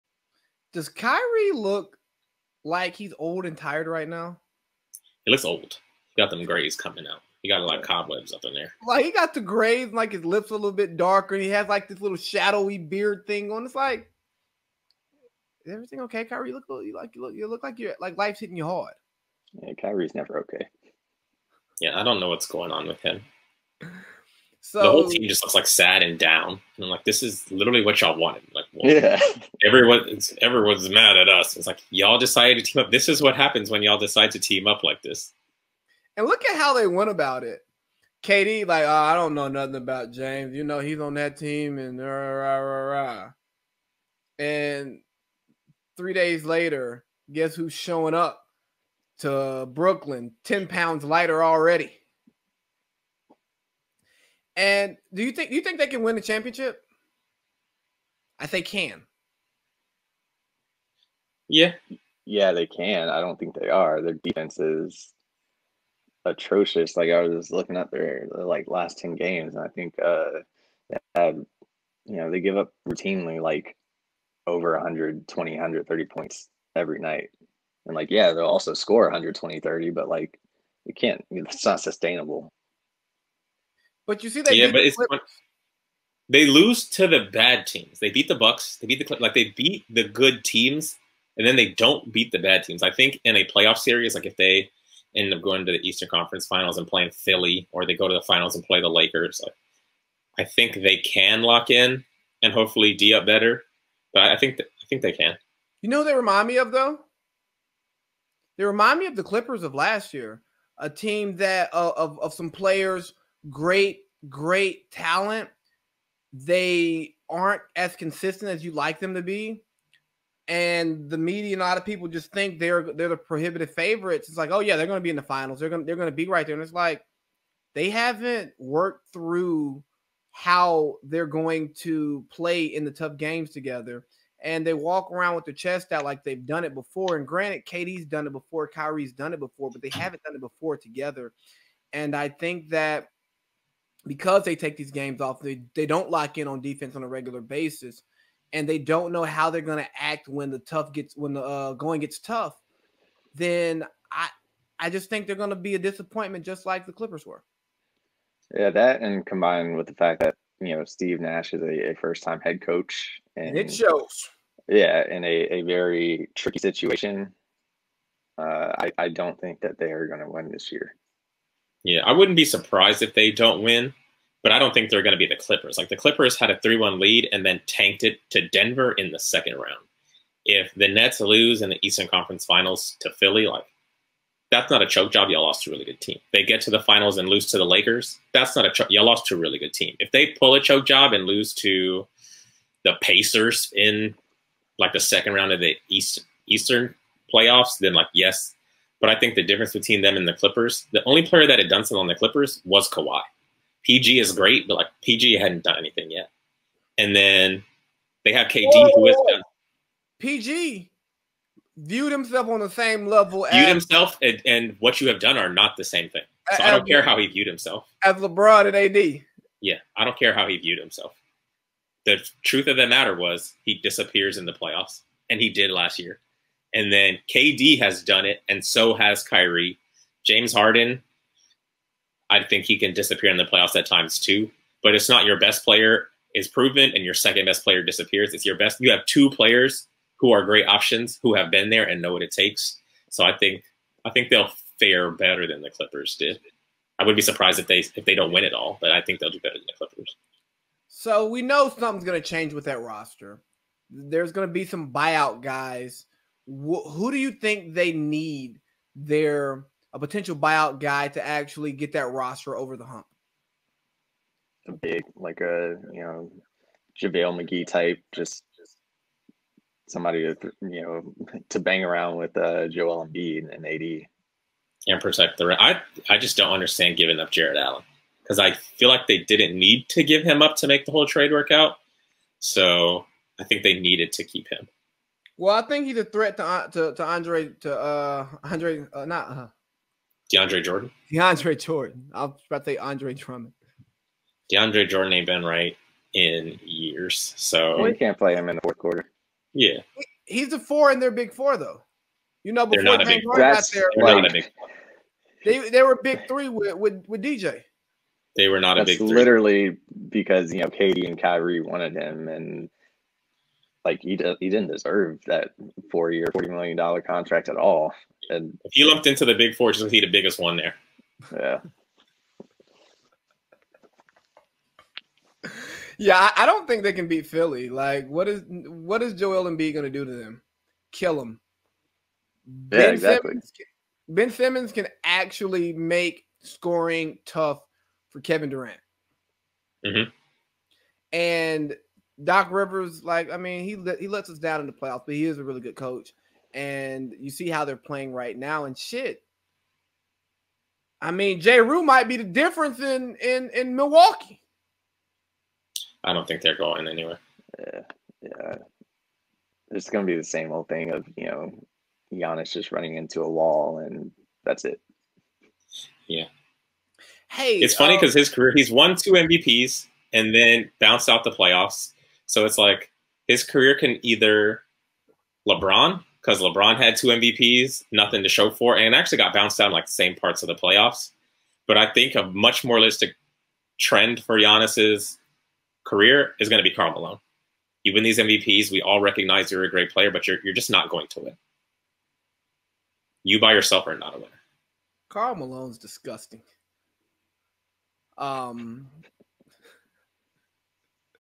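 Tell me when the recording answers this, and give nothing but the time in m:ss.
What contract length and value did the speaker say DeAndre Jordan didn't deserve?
5:15.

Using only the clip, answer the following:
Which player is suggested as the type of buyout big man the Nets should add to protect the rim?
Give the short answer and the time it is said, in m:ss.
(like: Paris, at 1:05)
JaVale McGee, at 4:27.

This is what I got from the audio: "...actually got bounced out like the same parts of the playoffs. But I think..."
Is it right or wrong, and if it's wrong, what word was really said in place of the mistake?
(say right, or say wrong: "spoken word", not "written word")
right.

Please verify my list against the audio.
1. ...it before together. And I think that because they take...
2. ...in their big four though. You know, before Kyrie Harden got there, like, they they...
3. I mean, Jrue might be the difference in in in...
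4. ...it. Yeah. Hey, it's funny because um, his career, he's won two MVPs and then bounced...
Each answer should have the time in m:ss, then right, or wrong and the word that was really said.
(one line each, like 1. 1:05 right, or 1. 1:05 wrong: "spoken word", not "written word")
1. 2:20 right
2. 5:00 wrong: "James", not "Kyrie"
3. 5:51 right
4. 6:04 right.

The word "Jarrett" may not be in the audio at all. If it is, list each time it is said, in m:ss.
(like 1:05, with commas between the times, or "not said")
4:37.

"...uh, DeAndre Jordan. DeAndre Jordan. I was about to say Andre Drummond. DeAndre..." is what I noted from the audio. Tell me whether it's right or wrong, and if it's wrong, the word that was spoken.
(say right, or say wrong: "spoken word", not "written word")
right.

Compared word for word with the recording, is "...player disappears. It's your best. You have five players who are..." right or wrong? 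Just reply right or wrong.
wrong.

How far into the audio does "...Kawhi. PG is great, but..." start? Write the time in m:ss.
3:22.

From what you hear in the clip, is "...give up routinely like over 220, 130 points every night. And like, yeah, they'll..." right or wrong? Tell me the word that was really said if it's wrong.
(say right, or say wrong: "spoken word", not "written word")
wrong: "120", not "220".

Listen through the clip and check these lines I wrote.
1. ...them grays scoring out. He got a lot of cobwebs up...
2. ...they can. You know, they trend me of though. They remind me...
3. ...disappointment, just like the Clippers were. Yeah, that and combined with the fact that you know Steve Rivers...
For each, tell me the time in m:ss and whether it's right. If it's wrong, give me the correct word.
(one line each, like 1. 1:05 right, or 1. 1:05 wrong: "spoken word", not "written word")
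1. 0:06 wrong: "coming", not "scoring"
2. 1:45 wrong: "remind", not "trend"
3. 2:35 wrong: "Nash", not "Rivers".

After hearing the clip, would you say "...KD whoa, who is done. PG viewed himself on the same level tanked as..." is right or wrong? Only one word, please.
wrong.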